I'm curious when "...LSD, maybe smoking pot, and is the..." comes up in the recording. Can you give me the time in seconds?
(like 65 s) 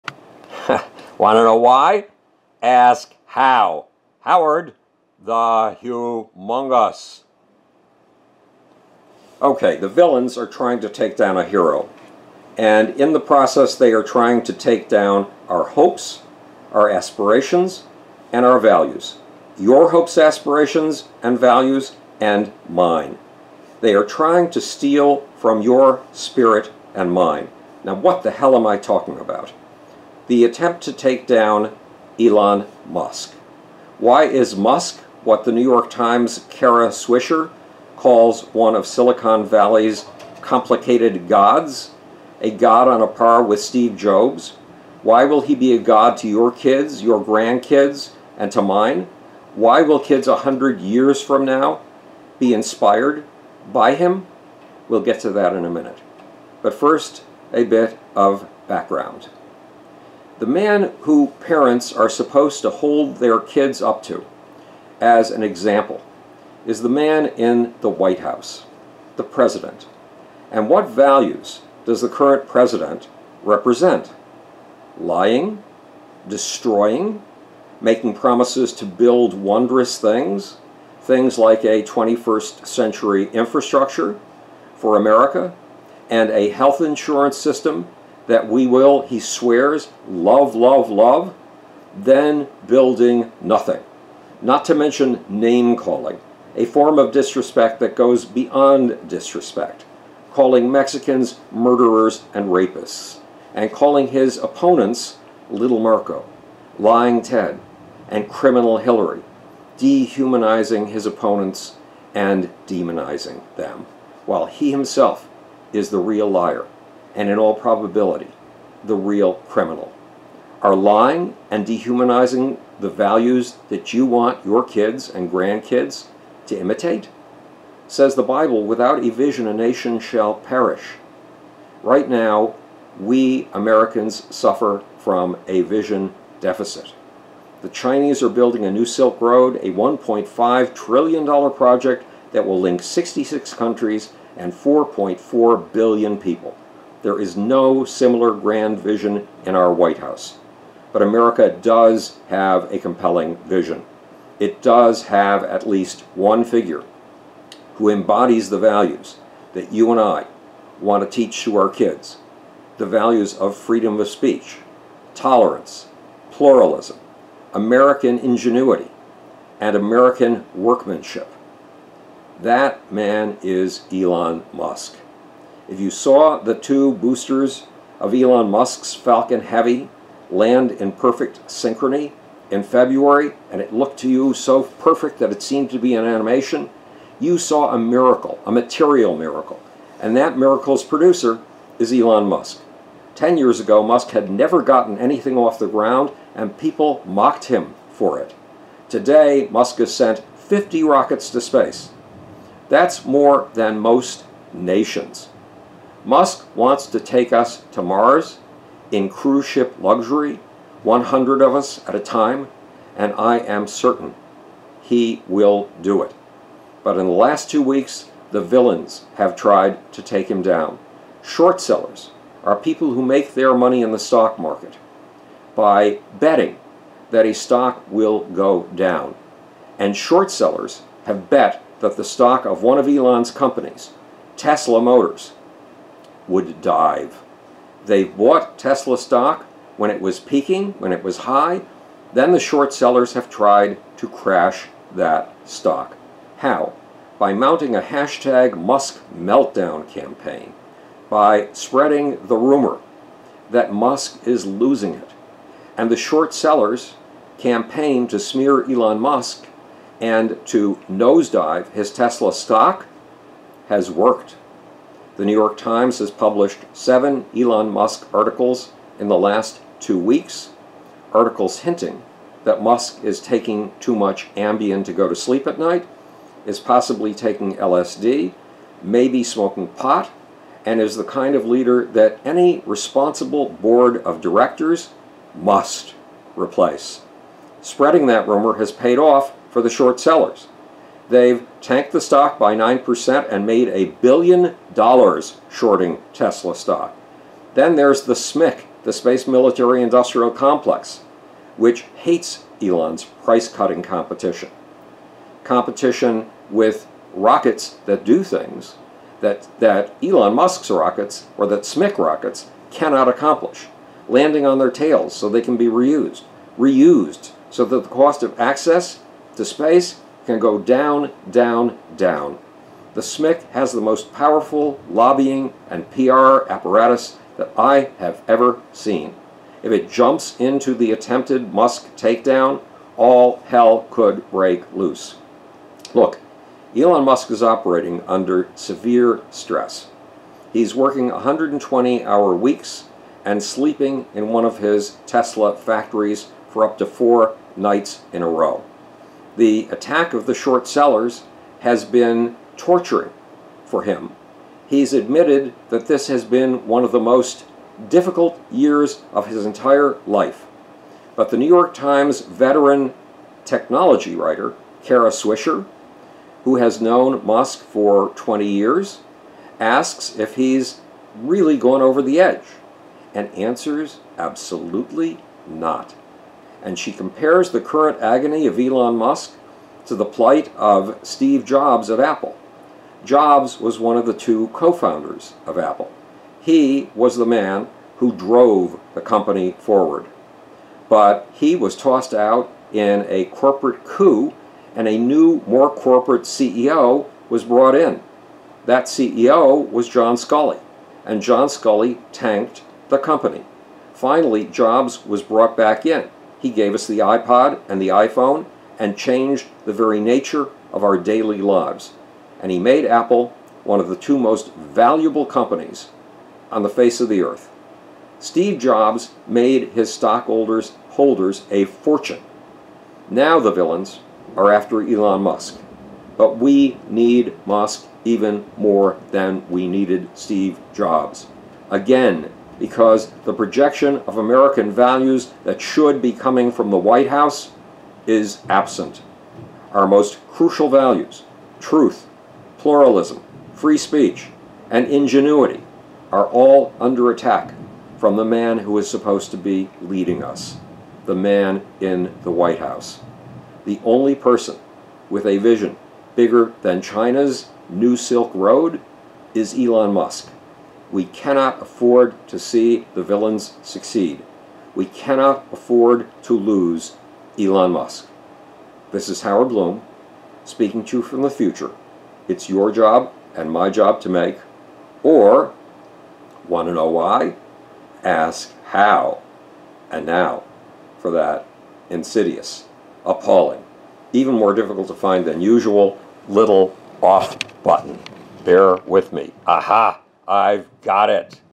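277 s.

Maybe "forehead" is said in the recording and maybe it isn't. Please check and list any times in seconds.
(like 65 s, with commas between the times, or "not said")
not said.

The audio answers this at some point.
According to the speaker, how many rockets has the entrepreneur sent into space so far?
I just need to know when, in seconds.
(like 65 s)
200 s.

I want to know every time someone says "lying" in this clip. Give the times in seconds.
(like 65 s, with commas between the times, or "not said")
74 s, 106 s, 120 s.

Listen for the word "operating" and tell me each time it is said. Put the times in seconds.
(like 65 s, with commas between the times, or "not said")
337 s.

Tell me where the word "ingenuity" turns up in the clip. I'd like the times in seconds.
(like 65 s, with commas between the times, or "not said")
168 s, 444 s.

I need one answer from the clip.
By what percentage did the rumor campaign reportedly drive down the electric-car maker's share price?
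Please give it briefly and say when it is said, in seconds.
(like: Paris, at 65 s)
9%, at 292 s.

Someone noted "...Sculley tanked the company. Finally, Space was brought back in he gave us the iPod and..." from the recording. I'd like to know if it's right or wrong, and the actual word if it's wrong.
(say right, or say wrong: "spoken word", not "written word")
wrong: "Jobs", not "Space".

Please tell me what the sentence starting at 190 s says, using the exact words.
And that miracle's producer is Elon Musk.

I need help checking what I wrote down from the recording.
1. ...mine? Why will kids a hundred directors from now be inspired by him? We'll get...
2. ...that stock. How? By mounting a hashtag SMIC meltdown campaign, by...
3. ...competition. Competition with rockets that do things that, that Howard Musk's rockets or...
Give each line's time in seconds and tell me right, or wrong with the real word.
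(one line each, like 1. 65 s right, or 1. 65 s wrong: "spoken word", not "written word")
1. 48 s wrong: "years", not "directors"
2. 244 s wrong: "Musk", not "SMIC"
3. 303 s wrong: "Elon", not "Howard".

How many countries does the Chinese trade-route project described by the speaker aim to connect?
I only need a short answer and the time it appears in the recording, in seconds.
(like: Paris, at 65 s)
66, at 142 s.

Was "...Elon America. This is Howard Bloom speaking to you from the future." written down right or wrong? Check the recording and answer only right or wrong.
wrong.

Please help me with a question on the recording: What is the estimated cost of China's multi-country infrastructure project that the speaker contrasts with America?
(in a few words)
$1.5 trillion.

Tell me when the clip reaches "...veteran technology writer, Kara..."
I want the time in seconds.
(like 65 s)
362 s.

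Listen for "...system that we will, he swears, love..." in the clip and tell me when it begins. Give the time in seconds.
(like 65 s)
87 s.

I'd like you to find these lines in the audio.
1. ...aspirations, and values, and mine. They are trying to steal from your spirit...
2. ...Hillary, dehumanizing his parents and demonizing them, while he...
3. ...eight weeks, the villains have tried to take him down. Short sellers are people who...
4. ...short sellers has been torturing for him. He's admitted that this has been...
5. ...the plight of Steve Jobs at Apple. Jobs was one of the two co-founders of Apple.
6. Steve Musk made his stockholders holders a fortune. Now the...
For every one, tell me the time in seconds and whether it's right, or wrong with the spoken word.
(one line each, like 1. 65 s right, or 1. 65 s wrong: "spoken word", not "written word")
1. 20 s right
2. 108 s wrong: "opponents", not "parents"
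3. 217 s wrong: "two", not "eight"
4. 350 s right
5. 379 s right
6. 418 s wrong: "Jobs", not "Musk".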